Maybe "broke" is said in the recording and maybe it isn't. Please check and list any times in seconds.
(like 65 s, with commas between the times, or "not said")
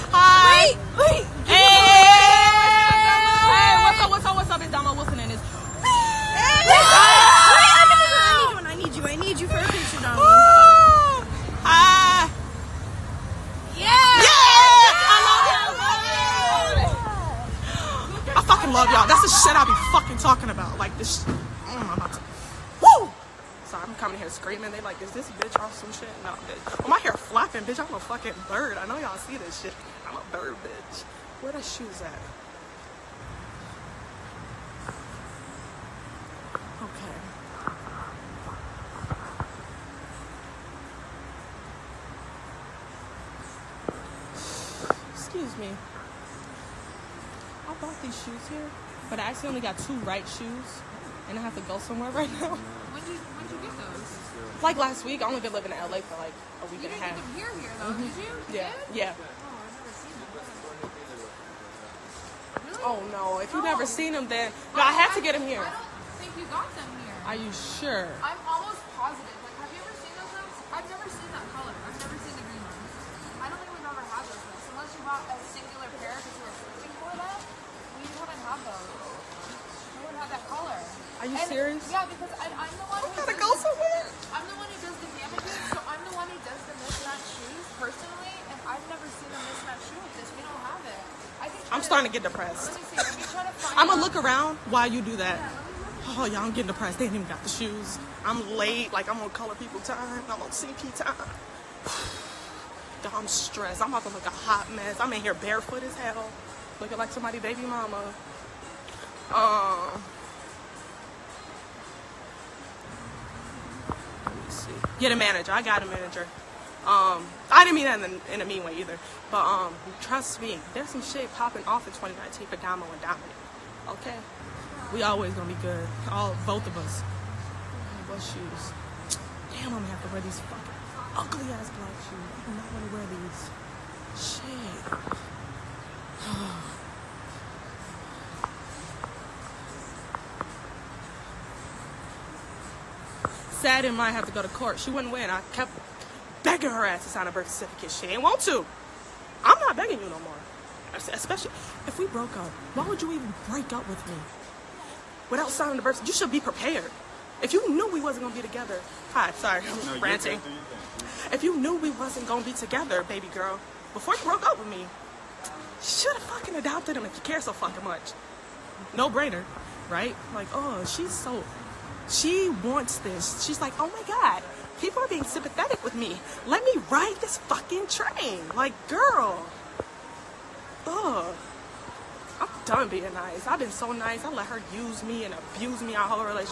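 152 s, 164 s.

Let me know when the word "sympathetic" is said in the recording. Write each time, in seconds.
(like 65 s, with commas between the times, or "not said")
175 s.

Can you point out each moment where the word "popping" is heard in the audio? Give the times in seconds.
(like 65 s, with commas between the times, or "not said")
121 s.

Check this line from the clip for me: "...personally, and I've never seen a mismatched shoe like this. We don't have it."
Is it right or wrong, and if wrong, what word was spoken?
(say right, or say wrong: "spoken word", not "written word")
right.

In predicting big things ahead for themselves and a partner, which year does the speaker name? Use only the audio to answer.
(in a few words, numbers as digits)
2019.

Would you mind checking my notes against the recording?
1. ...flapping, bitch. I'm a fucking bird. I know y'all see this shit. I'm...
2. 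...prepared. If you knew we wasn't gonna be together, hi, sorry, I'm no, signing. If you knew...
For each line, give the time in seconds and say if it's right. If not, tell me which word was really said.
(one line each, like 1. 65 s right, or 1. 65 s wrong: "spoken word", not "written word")
1. 27 s right
2. 156 s wrong: "ranting", not "signing".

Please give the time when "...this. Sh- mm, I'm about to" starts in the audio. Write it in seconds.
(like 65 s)
20 s.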